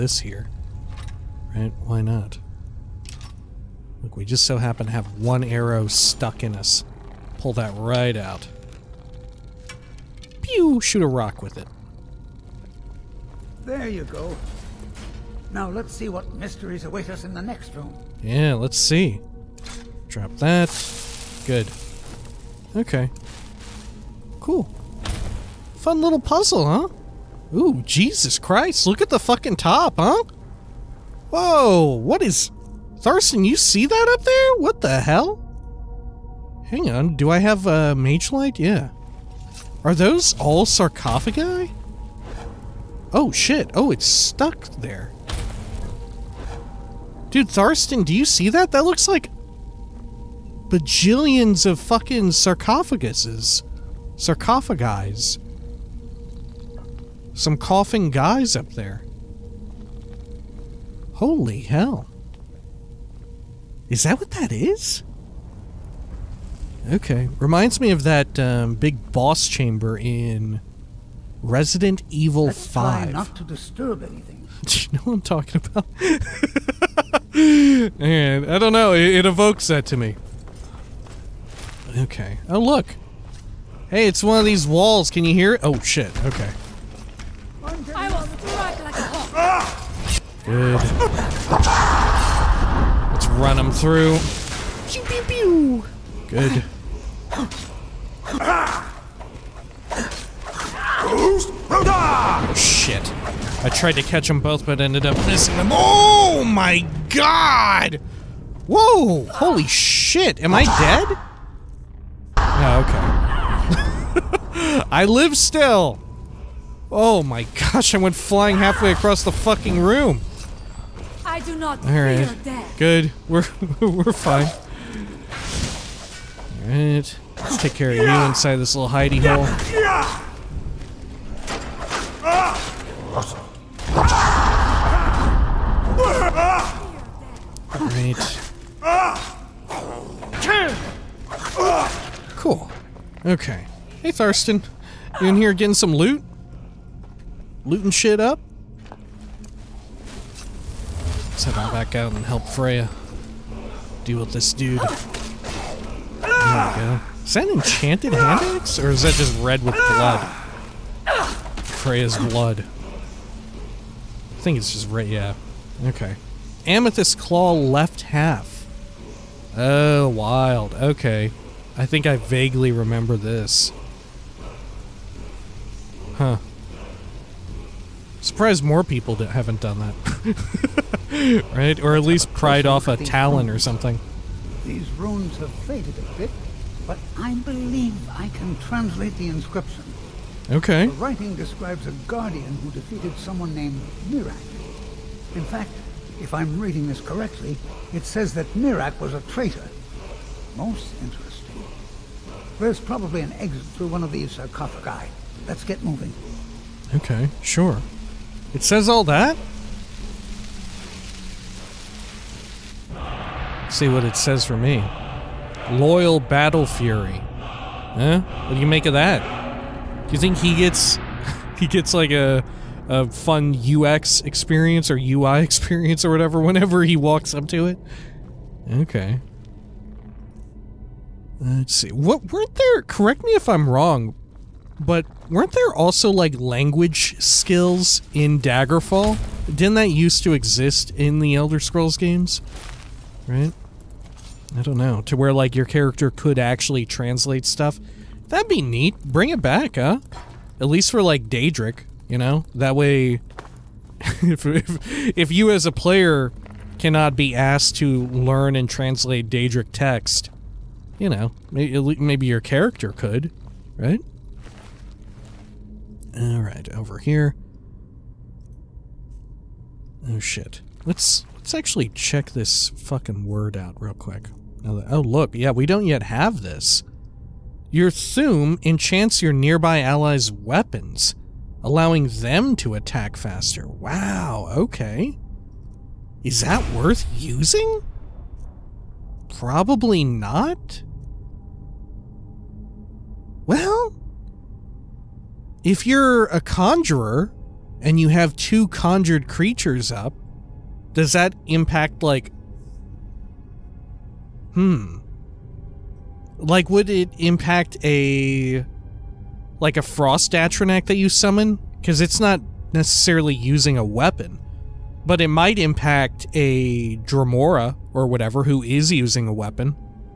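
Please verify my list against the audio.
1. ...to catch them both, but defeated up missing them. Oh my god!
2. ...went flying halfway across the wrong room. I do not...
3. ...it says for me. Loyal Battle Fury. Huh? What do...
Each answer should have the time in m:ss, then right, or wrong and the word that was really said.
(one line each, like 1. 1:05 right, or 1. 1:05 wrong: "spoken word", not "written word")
1. 1:43 wrong: "ended", not "defeated"
2. 1:57 wrong: "fucking", not "wrong"
3. 3:34 right.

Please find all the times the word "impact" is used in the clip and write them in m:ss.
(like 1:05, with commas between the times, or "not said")
5:01, 5:07, 5:15.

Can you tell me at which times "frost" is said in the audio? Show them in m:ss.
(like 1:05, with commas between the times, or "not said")
5:09.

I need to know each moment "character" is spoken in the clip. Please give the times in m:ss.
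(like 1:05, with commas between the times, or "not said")
4:05, 4:22.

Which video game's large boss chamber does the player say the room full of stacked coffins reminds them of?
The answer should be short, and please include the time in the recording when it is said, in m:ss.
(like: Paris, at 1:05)
Resident Evil 5, at 1:11.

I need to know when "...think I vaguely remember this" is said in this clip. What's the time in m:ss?
2:51.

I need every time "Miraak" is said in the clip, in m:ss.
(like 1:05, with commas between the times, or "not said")
3:14, 3:18.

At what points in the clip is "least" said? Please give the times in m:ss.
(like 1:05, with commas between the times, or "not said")
3:02, 4:10.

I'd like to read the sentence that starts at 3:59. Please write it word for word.
Didn't that used to exist in the Elder Scrolls games?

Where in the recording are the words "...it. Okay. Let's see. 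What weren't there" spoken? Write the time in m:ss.
3:47.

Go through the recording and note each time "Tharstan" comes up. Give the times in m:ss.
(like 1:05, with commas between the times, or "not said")
0:32, 0:47.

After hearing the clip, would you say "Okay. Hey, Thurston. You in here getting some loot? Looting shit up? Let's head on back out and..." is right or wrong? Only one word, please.
right.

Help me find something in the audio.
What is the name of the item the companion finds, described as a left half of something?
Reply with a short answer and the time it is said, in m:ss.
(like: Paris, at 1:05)
Amethyst Claw, at 2:46.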